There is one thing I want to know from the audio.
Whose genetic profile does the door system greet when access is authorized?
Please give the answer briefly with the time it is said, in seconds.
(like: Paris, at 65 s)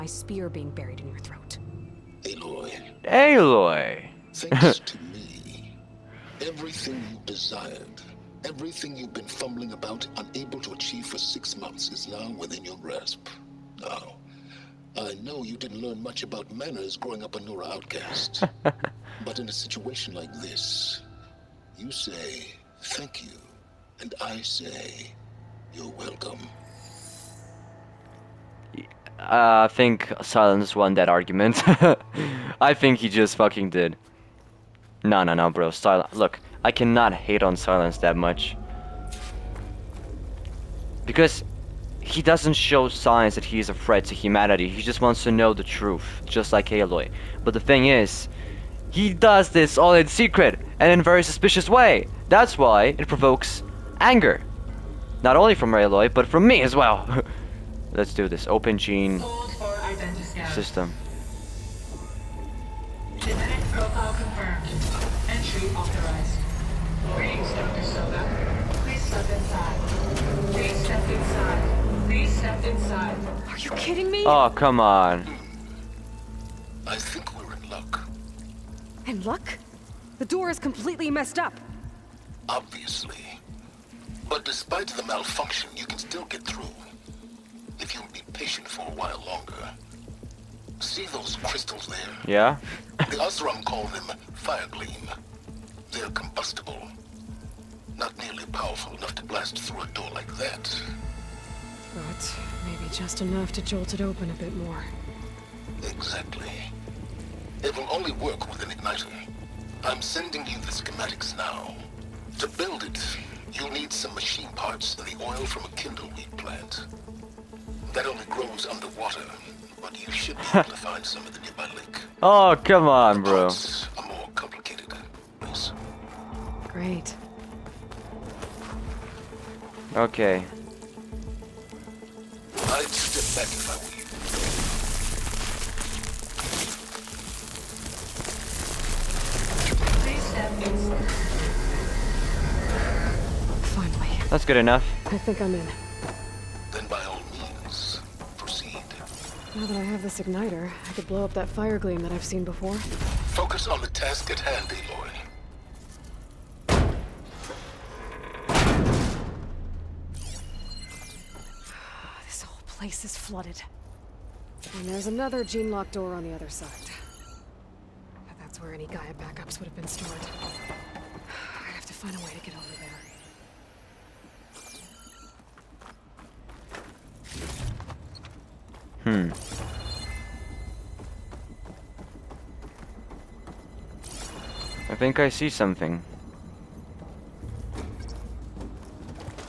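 Dr. Sobek, at 67 s.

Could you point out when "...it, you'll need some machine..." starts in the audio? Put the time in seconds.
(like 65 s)
112 s.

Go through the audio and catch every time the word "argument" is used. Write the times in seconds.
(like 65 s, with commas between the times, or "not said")
31 s.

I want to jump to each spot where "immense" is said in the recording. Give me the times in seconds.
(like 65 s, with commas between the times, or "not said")
not said.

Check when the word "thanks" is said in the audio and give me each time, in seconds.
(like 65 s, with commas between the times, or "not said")
4 s, 22 s.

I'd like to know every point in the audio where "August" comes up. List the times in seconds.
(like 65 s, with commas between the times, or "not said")
not said.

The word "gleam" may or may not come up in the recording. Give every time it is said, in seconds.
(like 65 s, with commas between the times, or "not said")
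94 s, 151 s.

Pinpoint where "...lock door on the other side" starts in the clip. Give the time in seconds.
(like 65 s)
165 s.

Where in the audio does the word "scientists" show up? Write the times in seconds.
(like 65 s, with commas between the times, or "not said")
not said.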